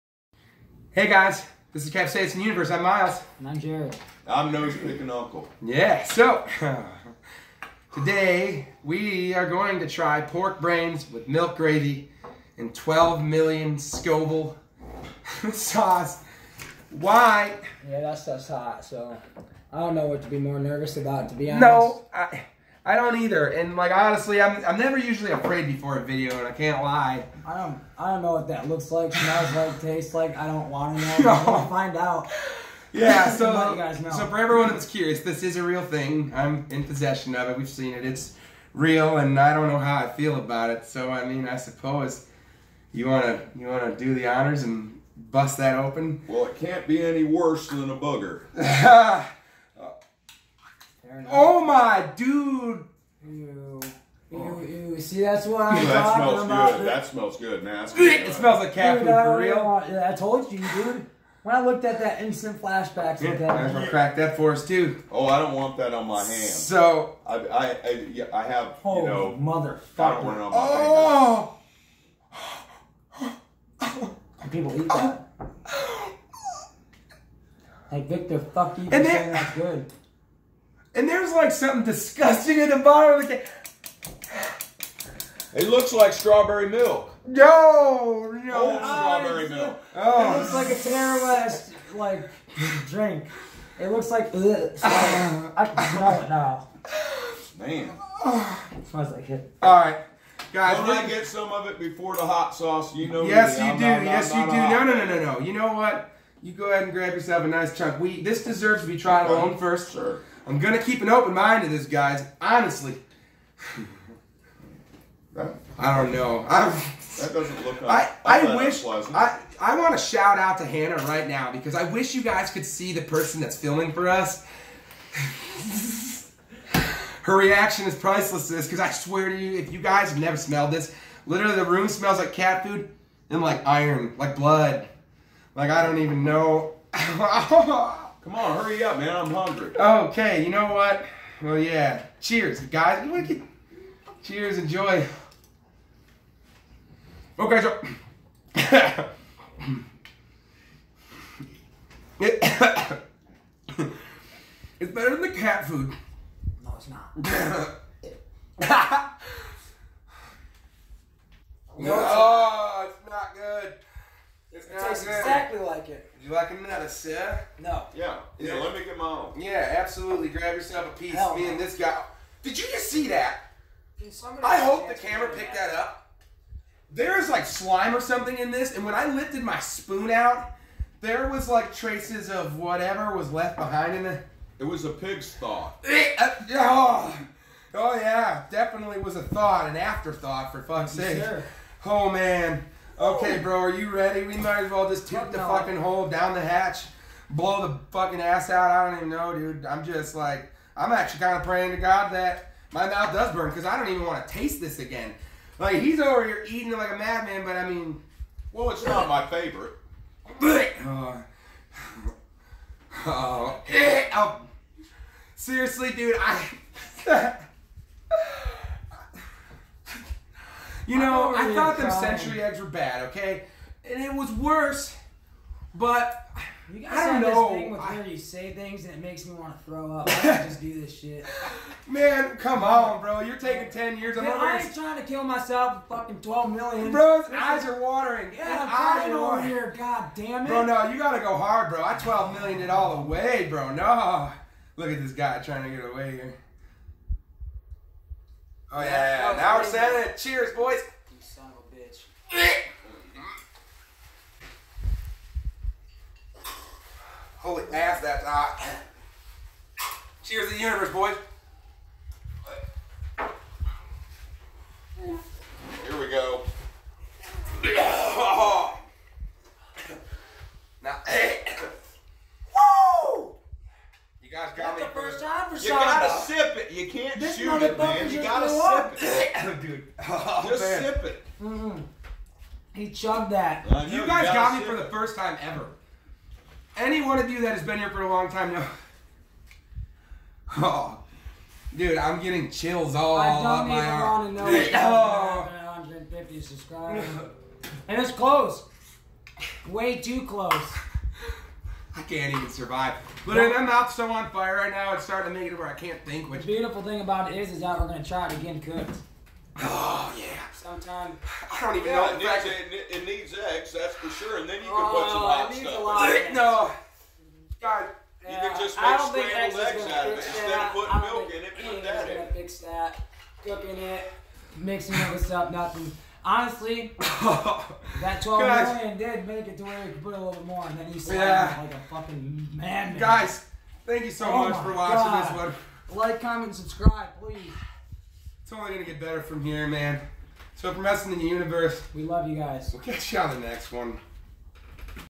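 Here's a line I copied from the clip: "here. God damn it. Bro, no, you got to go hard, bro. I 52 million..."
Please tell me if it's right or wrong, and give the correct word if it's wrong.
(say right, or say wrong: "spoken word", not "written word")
wrong: "12", not "52".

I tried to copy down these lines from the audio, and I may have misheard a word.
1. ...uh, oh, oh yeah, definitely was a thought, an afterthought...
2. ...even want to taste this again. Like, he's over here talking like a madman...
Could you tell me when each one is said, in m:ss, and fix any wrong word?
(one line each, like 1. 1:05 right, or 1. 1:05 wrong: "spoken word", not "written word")
1. 3:06 right
2. 3:23 wrong: "eating", not "talking".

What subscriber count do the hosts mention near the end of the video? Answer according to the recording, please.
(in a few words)
150.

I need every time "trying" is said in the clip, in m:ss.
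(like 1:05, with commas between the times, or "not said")
3:54, 4:05.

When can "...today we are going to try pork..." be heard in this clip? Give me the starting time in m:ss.
0:07.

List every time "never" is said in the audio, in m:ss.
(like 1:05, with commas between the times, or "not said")
0:24, 2:10.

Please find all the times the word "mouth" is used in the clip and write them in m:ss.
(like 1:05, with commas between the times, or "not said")
3:22, 5:03.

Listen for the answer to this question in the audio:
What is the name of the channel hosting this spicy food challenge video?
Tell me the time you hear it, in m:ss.
0:01.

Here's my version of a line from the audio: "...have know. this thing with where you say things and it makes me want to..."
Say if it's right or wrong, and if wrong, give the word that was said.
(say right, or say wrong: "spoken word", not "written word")
right.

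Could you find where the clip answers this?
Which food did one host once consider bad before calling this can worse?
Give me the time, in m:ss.
3:41.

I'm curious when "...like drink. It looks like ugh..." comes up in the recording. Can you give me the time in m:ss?
1:31.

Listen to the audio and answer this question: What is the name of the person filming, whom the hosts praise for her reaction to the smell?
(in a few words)
Hannah.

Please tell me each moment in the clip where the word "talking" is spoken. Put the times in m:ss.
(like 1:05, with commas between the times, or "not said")
0:56.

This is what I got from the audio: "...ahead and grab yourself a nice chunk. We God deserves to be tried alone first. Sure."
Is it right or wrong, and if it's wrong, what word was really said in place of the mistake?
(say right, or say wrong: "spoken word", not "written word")
wrong: "This", not "God".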